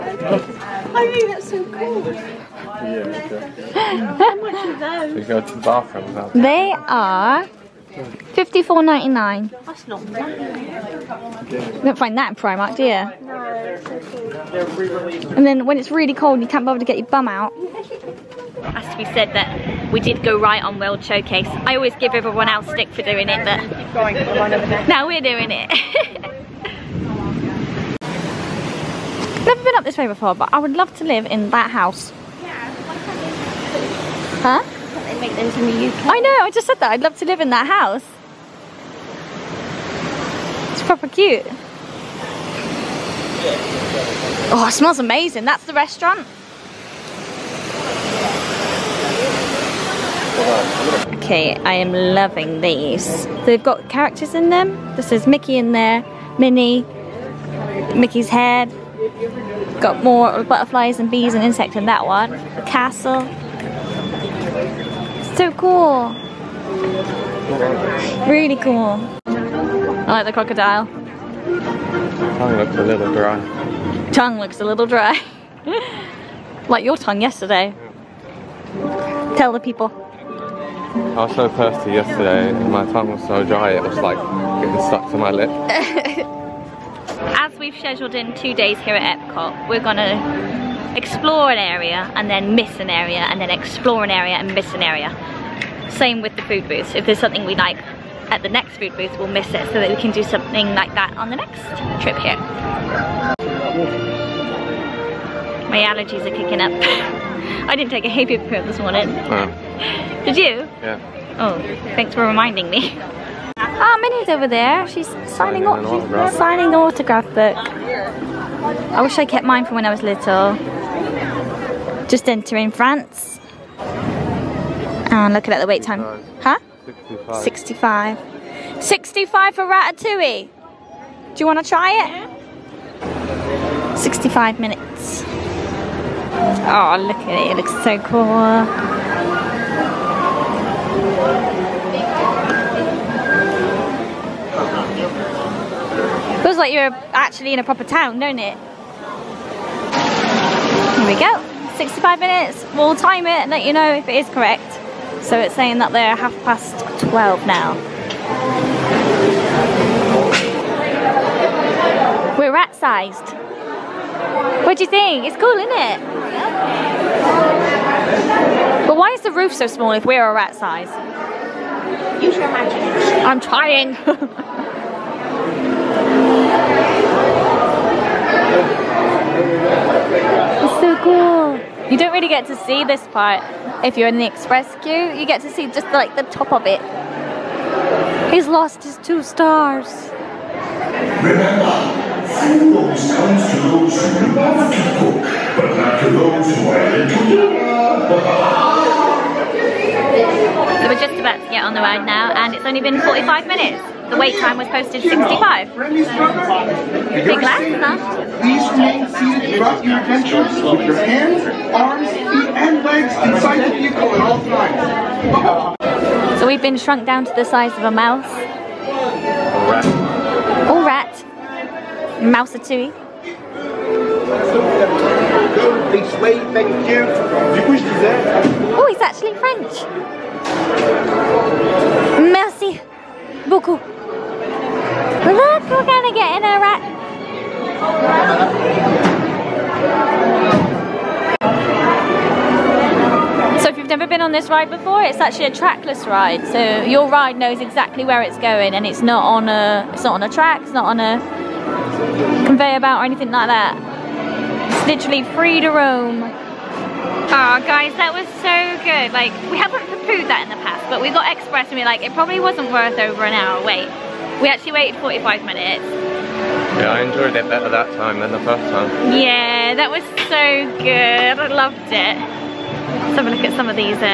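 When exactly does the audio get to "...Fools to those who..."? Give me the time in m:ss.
3:12.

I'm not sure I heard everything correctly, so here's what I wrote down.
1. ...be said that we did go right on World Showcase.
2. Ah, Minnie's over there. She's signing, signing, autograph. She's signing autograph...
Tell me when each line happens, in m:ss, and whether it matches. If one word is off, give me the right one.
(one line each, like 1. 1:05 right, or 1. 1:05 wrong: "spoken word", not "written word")
1. 0:18 right
2. 1:53 right.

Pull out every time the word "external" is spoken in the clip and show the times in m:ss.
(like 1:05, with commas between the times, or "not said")
not said.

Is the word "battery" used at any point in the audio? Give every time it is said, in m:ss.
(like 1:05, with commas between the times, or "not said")
not said.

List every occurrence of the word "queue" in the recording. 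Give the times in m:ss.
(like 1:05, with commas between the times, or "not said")
3:04.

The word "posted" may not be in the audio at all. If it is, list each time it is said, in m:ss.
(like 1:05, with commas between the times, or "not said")
3:24.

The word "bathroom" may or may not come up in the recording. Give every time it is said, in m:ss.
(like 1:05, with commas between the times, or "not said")
0:05.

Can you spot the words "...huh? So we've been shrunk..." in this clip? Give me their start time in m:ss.
3:35.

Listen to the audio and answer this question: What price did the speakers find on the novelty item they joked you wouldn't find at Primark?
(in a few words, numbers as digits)
54.99.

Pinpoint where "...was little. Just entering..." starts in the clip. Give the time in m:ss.
1:59.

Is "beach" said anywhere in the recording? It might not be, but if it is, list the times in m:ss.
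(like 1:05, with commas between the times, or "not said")
not said.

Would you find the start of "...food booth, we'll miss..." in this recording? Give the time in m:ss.
1:38.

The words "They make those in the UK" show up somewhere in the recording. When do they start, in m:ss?
0:35.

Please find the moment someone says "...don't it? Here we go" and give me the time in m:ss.
2:28.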